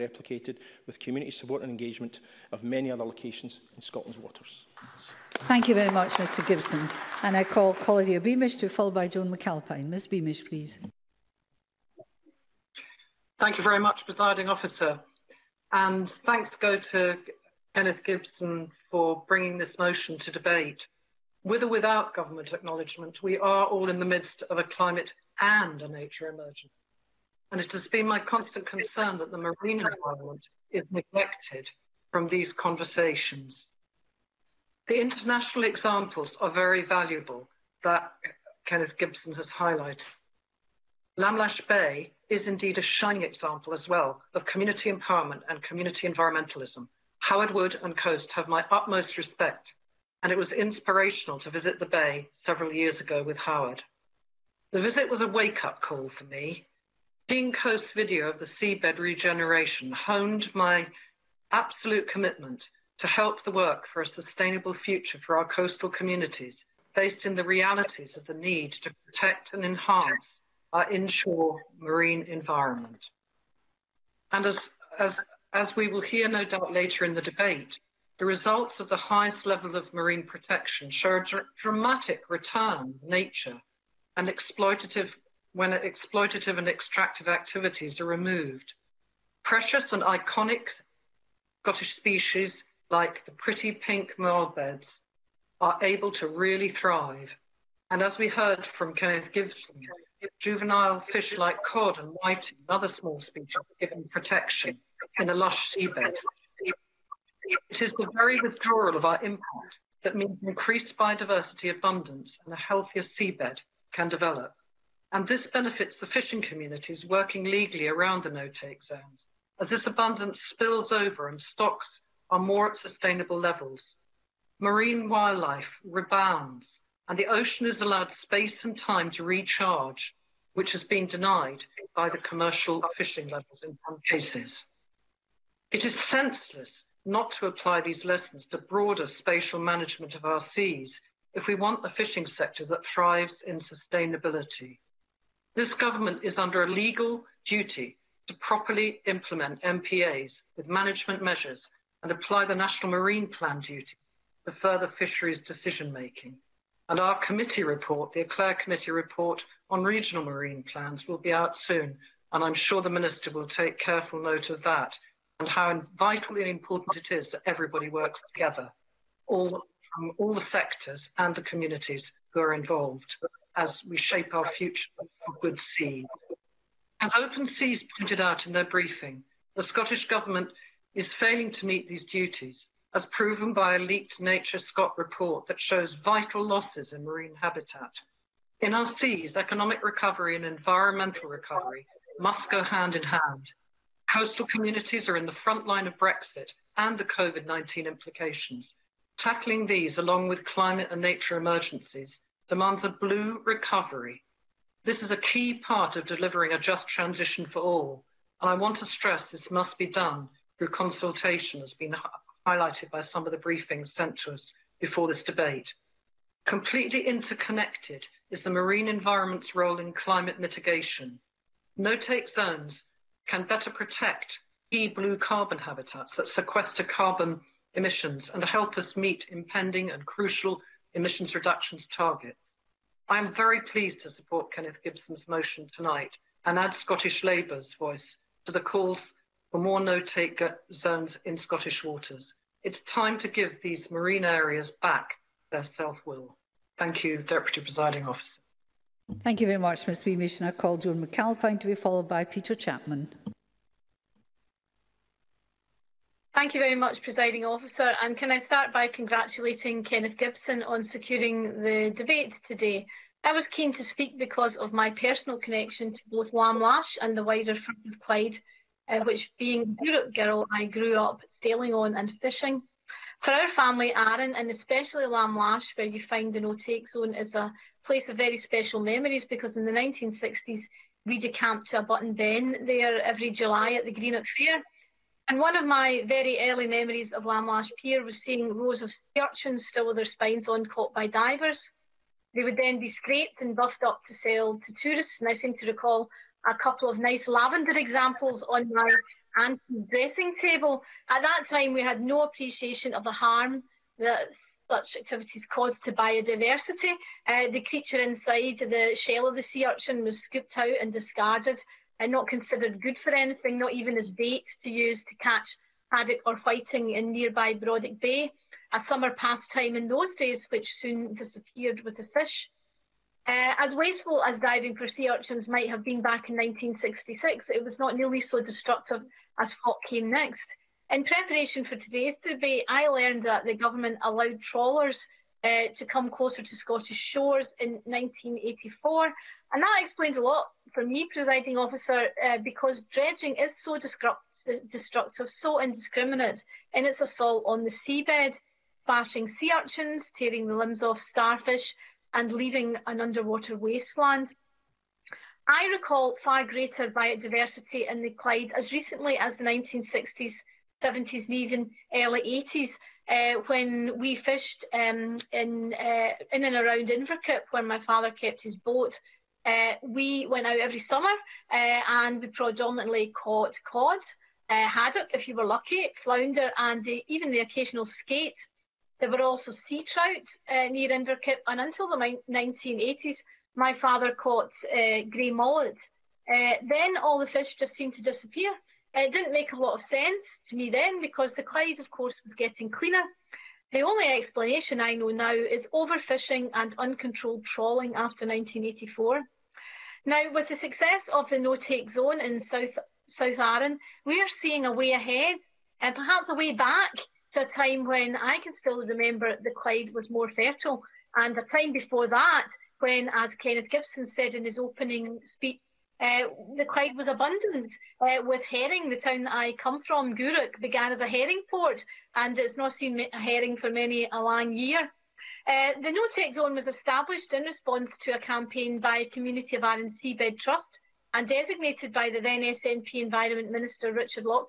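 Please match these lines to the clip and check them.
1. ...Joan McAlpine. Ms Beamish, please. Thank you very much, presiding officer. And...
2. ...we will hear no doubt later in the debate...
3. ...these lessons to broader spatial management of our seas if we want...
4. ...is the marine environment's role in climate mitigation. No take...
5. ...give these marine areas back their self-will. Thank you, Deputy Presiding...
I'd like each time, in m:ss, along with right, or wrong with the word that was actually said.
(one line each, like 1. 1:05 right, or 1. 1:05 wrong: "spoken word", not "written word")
1. 0:09 right
2. 1:15 right
3. 2:17 right
4. 3:38 right
5. 4:03 right.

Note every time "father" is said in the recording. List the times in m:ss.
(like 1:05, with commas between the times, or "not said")
6:07, 6:23.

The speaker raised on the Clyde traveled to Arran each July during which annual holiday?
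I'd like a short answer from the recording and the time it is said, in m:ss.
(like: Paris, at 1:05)
Greenock Fair, at 4:43.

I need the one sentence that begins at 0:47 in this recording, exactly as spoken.
Howard Wood and Coast have my utmost respect, and it was inspirational to visit the Bay several years ago with Howard.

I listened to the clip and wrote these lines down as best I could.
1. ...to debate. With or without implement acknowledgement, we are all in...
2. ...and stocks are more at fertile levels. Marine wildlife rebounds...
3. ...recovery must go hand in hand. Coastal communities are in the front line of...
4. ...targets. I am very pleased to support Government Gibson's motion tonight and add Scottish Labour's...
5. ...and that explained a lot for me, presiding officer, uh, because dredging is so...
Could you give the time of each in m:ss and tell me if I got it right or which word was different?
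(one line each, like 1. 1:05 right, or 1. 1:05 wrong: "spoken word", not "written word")
1. 0:20 wrong: "government", not "implement"
2. 2:01 wrong: "sustainable", not "fertile"
3. 3:11 right
4. 3:51 wrong: "Kenneth", not "Government"
5. 5:39 right.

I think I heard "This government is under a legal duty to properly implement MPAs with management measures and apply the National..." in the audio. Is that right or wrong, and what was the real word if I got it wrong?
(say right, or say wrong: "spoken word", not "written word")
right.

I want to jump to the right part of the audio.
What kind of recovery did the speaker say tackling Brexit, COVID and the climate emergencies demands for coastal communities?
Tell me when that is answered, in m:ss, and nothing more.
3:22.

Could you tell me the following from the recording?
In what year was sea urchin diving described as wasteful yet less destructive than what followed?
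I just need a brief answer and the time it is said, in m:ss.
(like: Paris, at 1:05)
1966, at 5:26.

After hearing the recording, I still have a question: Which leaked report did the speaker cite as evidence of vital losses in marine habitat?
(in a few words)
NatureScot report.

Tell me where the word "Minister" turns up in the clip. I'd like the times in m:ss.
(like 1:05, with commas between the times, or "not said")
2:42, 7:13.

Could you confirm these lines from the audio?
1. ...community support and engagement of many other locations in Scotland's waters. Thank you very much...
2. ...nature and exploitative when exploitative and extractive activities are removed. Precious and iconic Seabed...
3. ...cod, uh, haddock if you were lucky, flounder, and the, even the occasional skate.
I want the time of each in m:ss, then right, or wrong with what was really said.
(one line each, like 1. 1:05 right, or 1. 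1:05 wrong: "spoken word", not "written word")
1. 0:00 right
2. 1:23 wrong: "Scottish", not "Seabed"
3. 6:13 right.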